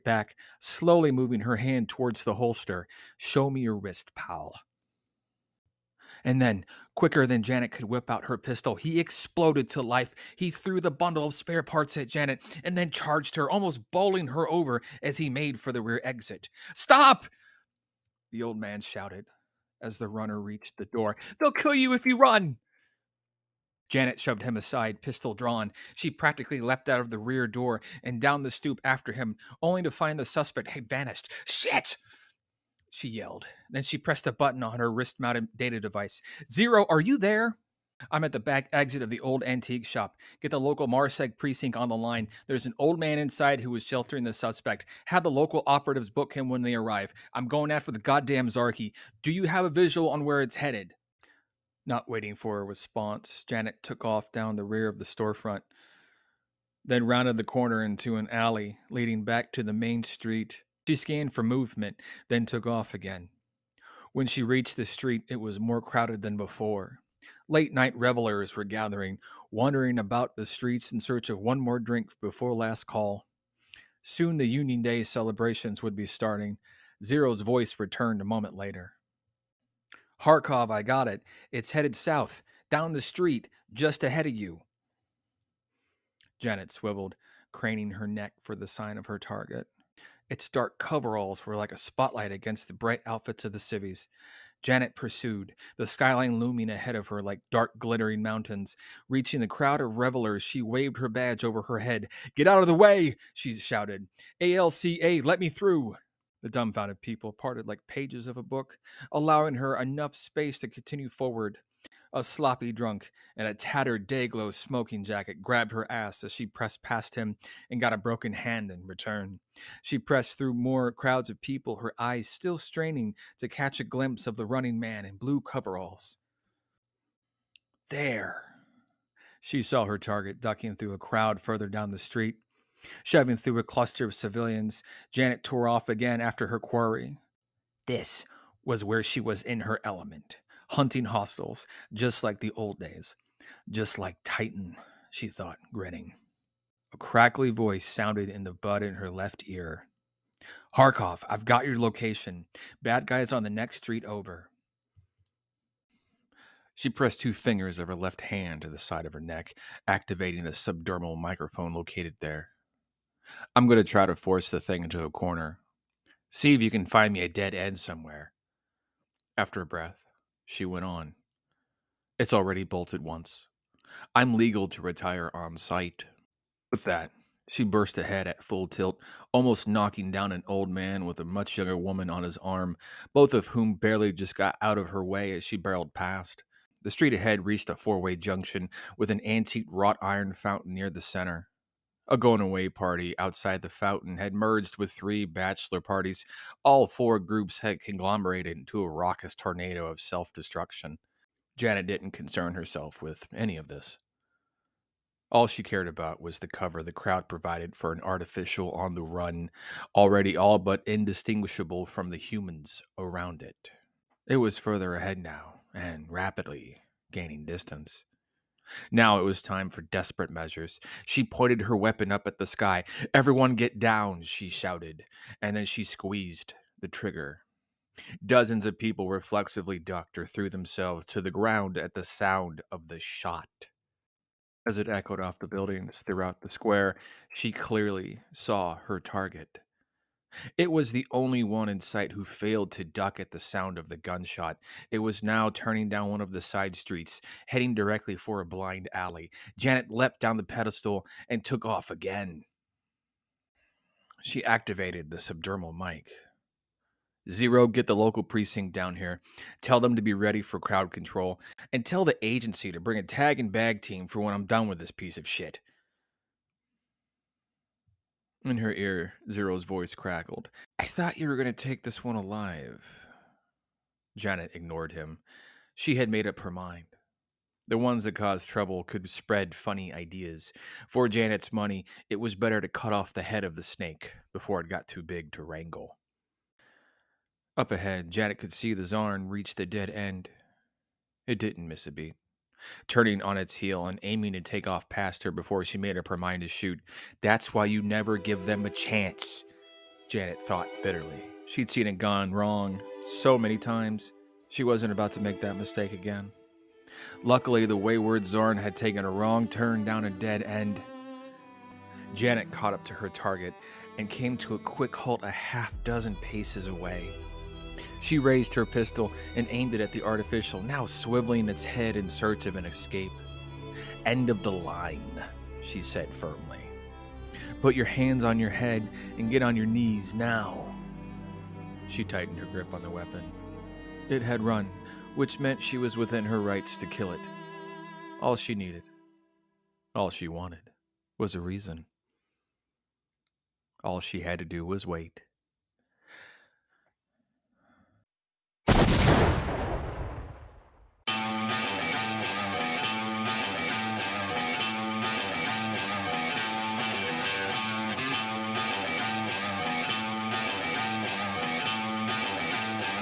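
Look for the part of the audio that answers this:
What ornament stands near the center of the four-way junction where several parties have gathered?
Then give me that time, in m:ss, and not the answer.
3:09.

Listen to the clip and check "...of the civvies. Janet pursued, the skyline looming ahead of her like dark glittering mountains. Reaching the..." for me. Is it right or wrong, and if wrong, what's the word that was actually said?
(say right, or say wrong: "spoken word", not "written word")
right.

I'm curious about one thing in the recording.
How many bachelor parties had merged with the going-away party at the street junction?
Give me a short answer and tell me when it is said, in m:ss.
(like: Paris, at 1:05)
3, at 3:14.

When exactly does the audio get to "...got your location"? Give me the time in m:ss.
2:31.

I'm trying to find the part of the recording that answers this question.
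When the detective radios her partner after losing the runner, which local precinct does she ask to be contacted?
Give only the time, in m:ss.
0:40.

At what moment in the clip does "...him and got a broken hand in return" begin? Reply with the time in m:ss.
1:57.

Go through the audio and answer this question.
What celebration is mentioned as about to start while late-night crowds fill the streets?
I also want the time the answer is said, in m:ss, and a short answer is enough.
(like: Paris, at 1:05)
Union Day, at 1:14.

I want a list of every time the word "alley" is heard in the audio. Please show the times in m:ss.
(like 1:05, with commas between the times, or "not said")
0:58, 4:08.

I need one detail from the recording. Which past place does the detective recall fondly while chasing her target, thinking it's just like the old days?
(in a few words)
Titan.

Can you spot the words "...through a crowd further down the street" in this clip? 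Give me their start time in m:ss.
2:10.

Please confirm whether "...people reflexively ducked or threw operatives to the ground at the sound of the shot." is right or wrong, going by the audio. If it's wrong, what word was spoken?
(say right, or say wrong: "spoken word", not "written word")
wrong: "themselves", not "operatives".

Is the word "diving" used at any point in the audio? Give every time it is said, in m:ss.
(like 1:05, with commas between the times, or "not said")
not said.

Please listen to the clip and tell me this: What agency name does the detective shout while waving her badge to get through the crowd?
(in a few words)
ALCA.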